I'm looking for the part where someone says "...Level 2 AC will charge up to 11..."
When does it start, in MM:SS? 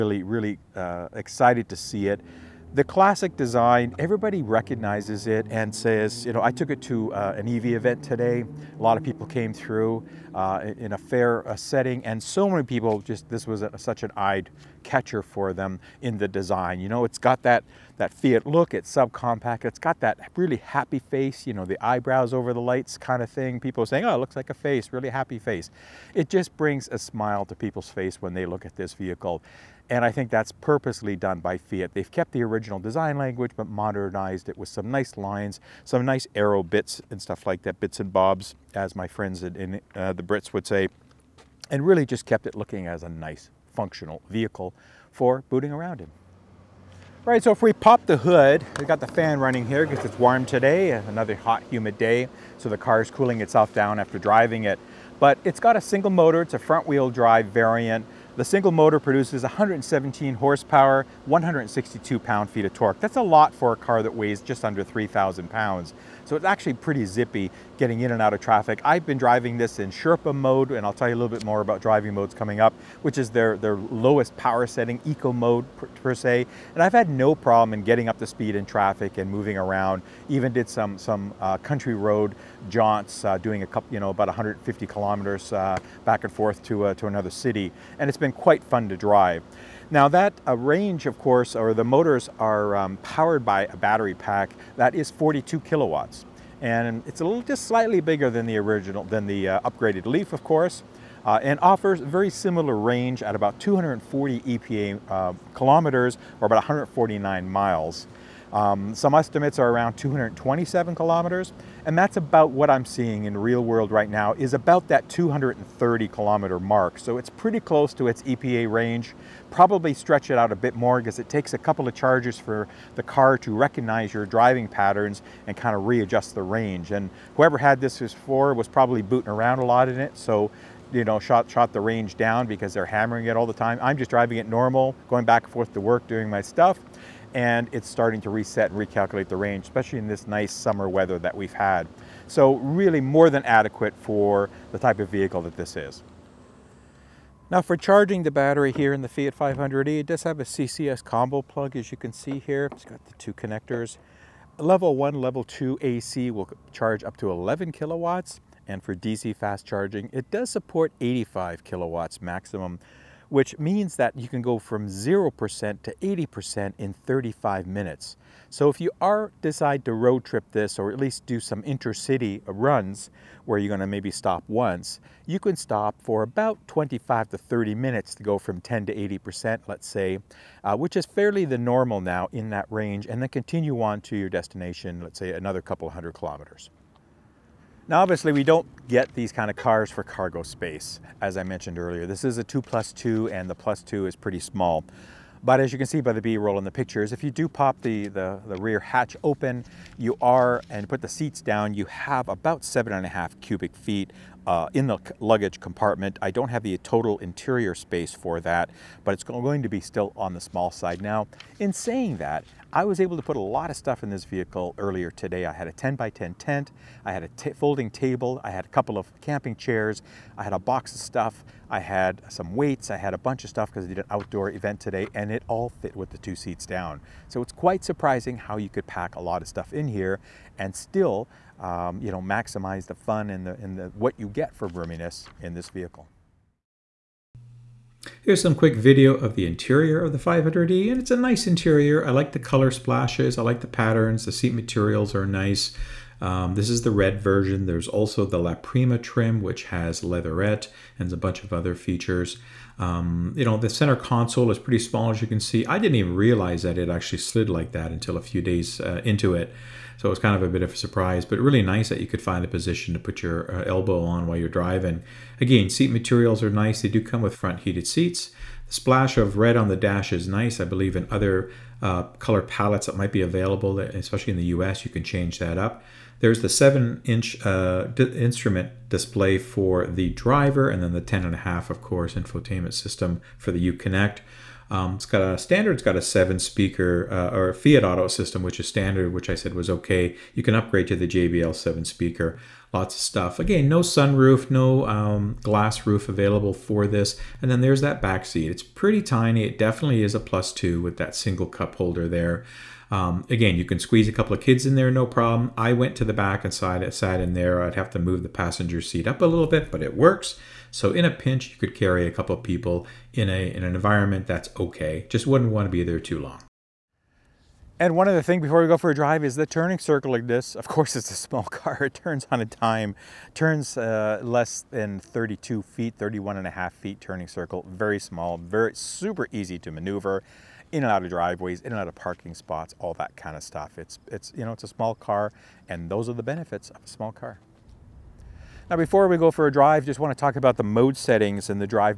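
02:35.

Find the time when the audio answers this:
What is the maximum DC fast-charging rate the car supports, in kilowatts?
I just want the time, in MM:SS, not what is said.
02:41.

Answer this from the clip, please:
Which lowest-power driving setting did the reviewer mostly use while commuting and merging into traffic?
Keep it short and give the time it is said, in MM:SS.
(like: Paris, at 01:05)
Sherpa mode, at 01:09.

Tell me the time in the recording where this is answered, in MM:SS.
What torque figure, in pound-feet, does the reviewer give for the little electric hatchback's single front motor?
01:01.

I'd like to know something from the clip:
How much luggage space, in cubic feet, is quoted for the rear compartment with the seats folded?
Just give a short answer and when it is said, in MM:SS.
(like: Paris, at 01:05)
7.5 cubic feet, at 03:22.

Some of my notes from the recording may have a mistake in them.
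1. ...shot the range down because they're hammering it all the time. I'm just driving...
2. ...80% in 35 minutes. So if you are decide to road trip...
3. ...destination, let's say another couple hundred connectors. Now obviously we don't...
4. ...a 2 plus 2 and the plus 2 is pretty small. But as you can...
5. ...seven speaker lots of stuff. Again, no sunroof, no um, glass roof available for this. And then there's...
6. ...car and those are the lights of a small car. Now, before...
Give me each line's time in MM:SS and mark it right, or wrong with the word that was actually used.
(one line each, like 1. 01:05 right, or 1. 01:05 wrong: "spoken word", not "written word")
1. 02:11 right
2. 02:45 right
3. 03:04 wrong: "kilometers", not "connectors"
4. 03:12 right
5. 04:51 right
6. 05:34 wrong: "benefits", not "lights".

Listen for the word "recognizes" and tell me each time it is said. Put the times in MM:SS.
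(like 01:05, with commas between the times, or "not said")
00:04, 02:03.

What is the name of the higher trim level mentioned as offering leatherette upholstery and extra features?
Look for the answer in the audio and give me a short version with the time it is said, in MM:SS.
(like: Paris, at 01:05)
La Prima, at 04:08.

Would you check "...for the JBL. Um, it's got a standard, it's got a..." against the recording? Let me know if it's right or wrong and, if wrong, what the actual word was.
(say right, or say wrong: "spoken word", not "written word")
wrong: "UConnect", not "JBL".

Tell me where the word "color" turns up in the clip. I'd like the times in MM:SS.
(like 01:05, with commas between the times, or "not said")
04:02, 04:32.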